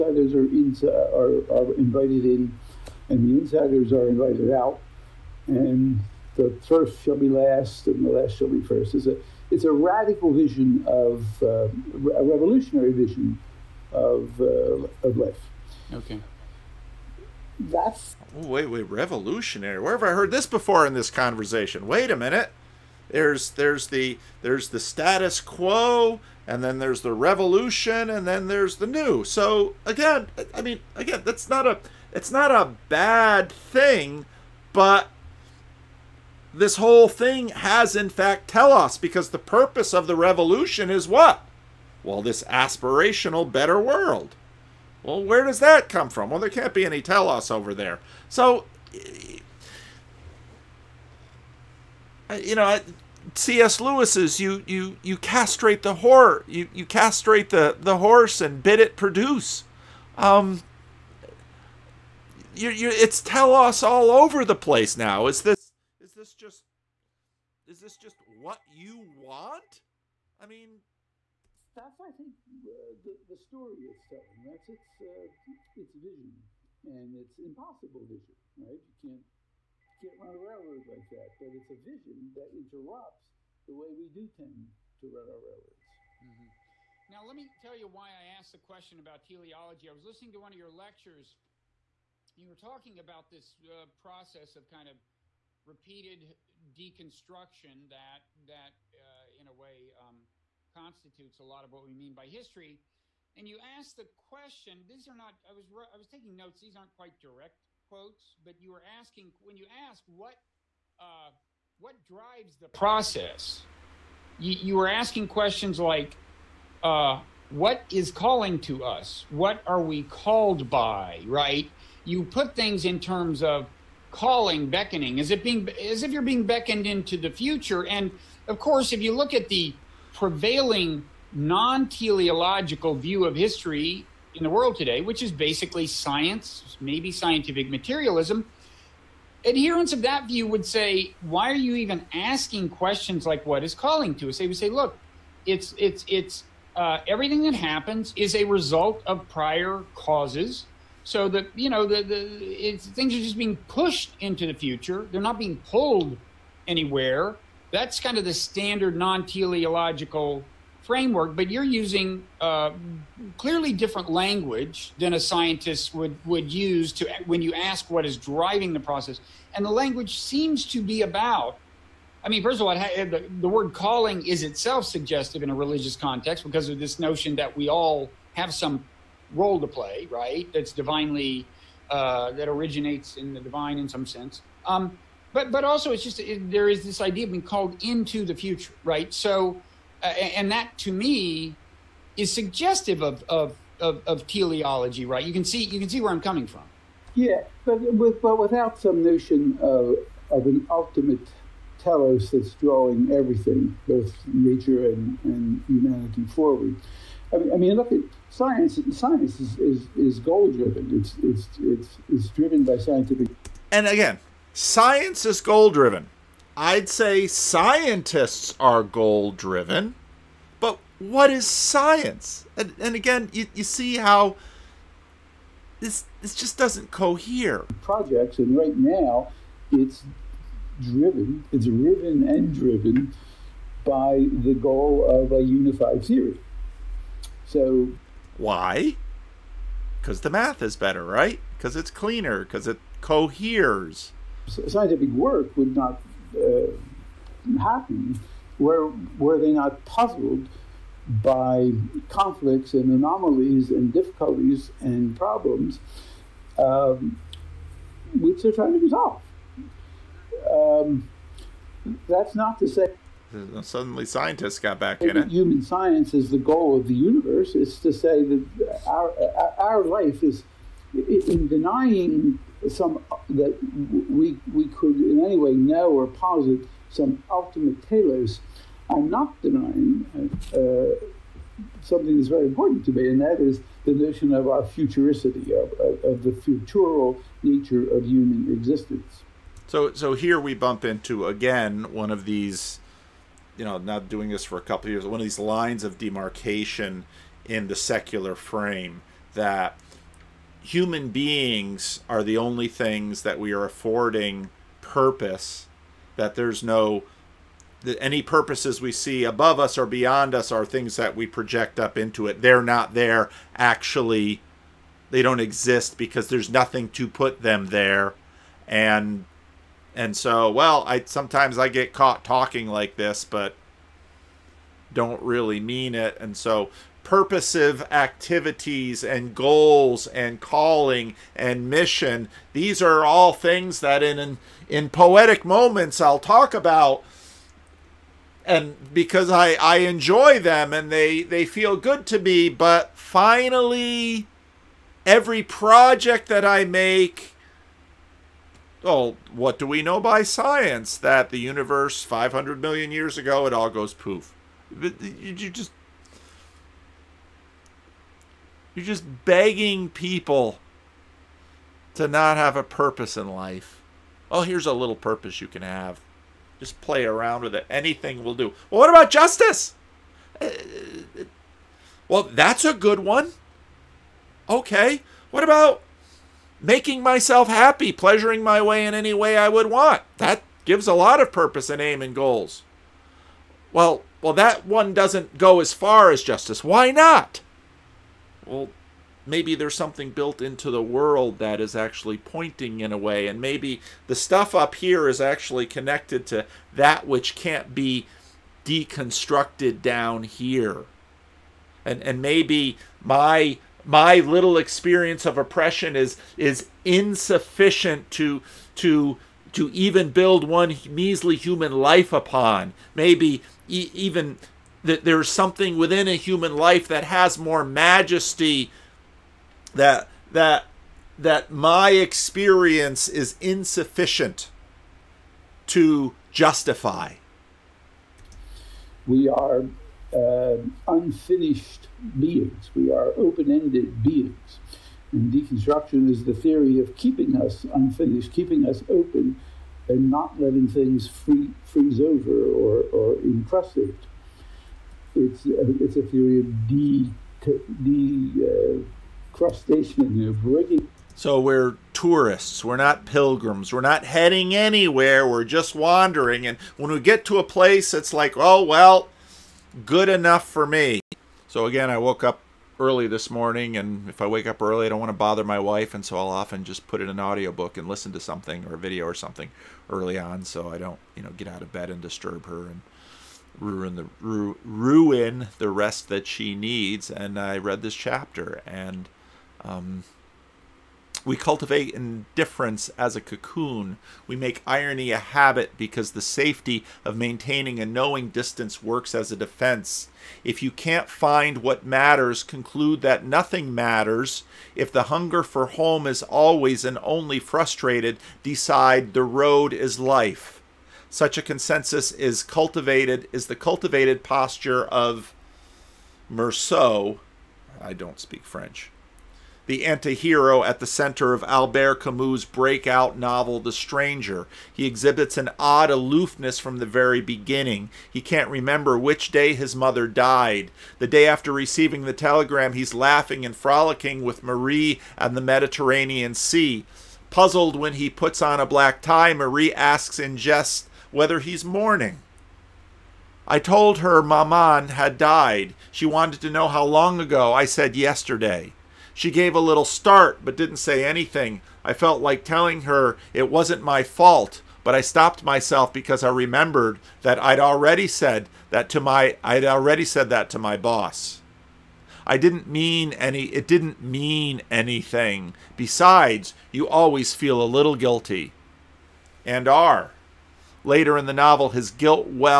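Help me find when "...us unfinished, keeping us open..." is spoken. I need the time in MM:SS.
07:17.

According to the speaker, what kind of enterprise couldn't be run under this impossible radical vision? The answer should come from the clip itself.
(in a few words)
a railroad.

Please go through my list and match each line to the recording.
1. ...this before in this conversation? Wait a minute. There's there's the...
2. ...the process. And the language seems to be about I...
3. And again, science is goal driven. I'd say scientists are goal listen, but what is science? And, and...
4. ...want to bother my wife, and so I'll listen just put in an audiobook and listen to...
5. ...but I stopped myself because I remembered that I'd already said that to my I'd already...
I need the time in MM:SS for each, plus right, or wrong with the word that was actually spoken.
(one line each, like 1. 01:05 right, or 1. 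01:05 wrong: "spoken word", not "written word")
1. 00:20 right
2. 02:48 right
3. 03:33 wrong: "driven", not "listen"
4. 07:44 wrong: "often", not "listen"
5. 09:04 right.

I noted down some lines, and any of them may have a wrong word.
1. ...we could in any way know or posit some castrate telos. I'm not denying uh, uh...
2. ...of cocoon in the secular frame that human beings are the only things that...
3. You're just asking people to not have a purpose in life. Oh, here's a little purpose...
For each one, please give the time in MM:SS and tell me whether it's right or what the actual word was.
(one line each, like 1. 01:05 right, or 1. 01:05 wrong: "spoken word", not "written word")
1. 04:34 wrong: "ultimate", not "castrate"
2. 04:55 wrong: "demarcation", not "cocoon"
3. 05:58 wrong: "begging", not "asking".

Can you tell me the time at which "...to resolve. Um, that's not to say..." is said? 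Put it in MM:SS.
04:18.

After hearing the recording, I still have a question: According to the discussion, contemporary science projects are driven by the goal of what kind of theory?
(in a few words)
a unified theory.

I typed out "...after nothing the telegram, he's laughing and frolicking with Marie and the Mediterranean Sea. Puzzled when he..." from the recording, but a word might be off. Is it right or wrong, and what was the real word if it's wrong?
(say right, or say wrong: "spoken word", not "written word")
wrong: "receiving", not "nothing".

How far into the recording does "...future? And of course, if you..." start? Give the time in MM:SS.
02:07.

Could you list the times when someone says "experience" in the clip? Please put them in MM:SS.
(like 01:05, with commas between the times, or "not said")
06:44, 07:01.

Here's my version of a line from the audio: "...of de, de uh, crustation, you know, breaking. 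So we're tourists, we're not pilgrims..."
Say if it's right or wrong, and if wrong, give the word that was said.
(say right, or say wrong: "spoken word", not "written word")
right.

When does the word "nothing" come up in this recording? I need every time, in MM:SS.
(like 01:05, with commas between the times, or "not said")
05:16, 08:13.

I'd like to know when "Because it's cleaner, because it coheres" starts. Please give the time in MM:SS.
04:01.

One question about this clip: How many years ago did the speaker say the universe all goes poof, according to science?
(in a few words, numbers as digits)
500 million.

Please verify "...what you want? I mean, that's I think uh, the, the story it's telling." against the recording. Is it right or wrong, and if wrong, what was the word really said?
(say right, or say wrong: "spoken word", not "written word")
right.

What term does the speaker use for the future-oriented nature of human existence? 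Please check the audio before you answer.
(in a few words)
futuricity.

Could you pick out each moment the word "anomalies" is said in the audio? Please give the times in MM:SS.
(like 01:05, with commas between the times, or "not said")
04:12.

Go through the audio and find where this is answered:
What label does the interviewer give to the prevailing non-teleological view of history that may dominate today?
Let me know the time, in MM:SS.
02:17.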